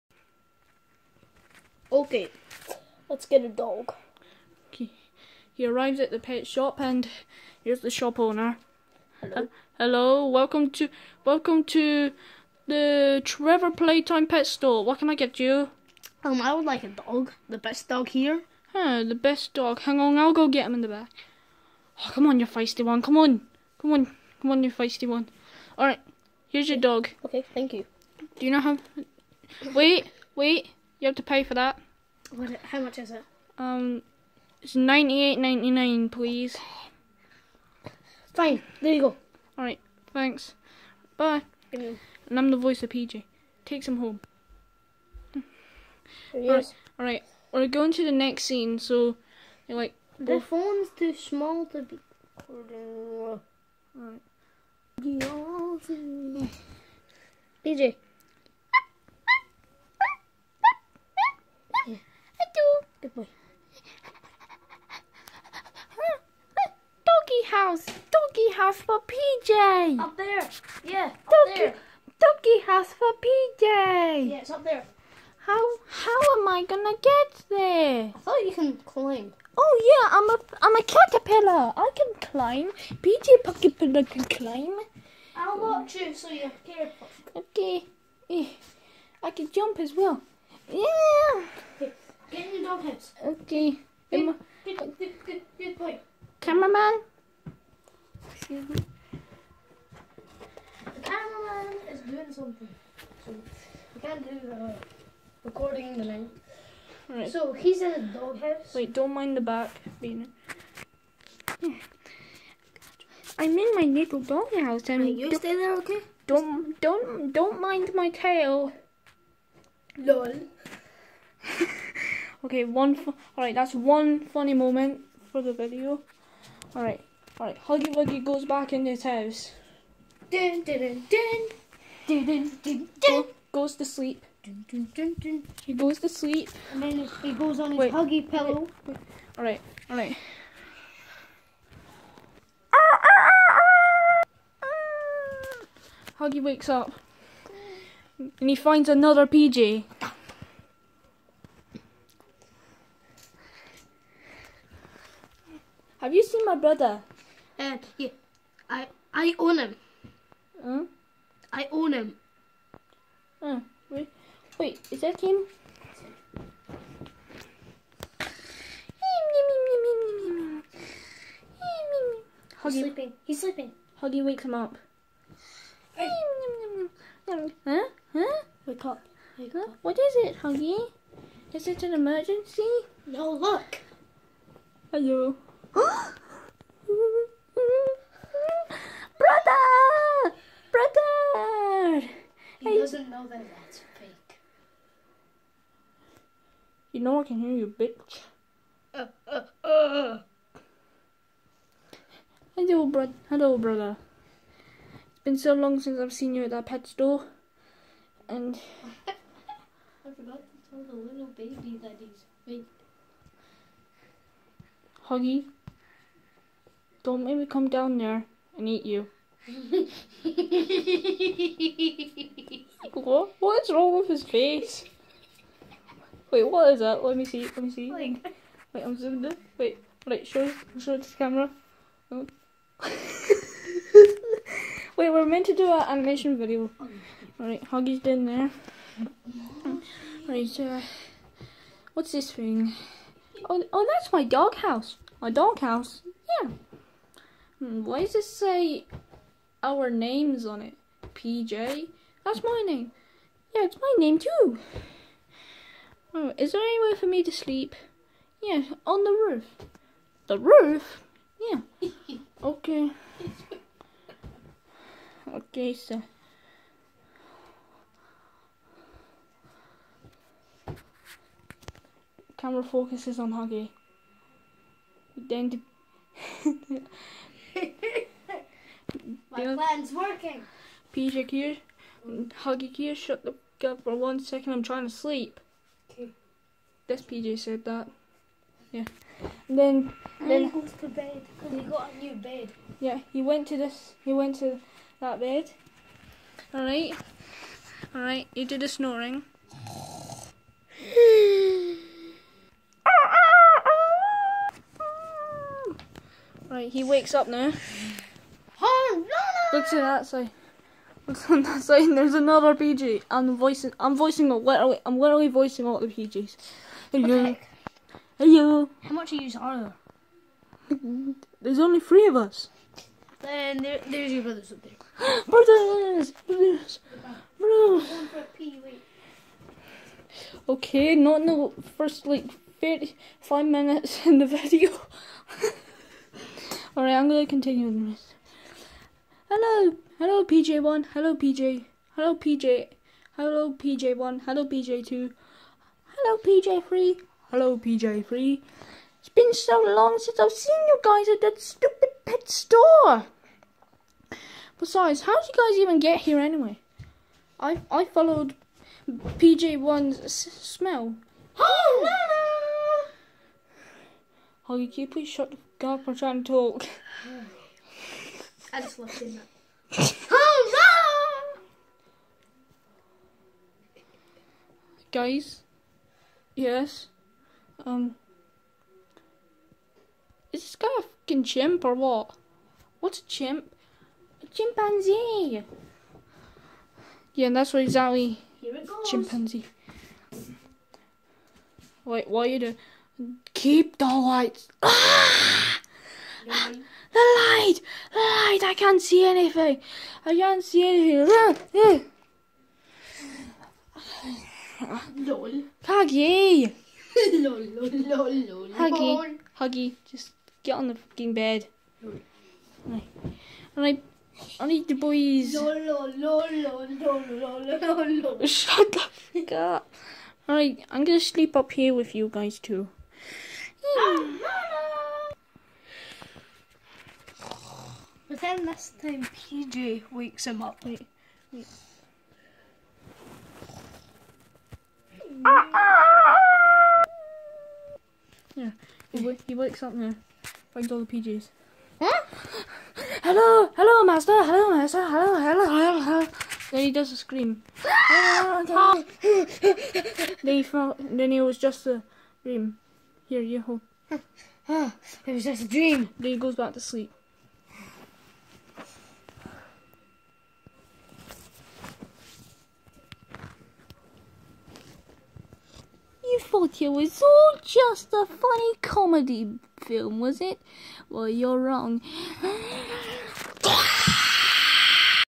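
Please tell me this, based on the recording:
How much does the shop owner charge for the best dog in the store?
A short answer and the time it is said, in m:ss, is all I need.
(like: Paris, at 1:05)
98.99, at 0:34.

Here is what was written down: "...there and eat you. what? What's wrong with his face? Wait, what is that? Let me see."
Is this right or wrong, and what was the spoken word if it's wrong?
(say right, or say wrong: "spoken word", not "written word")
right.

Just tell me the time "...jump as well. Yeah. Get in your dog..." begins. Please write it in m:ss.
1:29.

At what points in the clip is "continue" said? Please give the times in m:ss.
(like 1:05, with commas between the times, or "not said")
5:37.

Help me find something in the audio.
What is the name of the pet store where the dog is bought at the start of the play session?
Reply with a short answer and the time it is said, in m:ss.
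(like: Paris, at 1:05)
Trevor Playtime Pet Store, at 0:13.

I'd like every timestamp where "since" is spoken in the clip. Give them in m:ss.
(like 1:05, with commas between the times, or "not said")
3:25, 5:49.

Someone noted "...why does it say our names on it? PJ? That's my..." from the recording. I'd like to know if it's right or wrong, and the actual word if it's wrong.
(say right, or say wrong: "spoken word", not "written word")
right.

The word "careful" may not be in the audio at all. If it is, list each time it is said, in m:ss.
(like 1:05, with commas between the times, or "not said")
1:26.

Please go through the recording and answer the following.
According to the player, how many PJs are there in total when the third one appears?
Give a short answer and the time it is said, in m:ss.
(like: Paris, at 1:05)
3, at 5:21.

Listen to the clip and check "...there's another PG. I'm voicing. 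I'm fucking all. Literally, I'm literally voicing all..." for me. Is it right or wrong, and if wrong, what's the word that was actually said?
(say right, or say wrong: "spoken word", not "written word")
wrong: "voicing", not "fucking".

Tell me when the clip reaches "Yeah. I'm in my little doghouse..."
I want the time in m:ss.
1:51.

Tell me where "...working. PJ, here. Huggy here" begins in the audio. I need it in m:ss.
4:39.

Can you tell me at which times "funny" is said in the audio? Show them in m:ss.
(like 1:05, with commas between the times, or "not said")
2:04, 7:48.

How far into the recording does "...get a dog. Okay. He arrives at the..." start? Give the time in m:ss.
0:03.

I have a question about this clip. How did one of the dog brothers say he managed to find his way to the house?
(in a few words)
followed PJ1's smell.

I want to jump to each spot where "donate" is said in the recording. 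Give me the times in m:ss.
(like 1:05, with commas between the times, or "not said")
not said.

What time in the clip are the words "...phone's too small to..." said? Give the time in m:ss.
0:50.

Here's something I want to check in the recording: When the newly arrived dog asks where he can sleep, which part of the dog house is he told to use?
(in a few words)
the roof.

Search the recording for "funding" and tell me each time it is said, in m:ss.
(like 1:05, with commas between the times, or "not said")
not said.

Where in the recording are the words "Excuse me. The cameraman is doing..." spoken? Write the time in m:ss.
1:38.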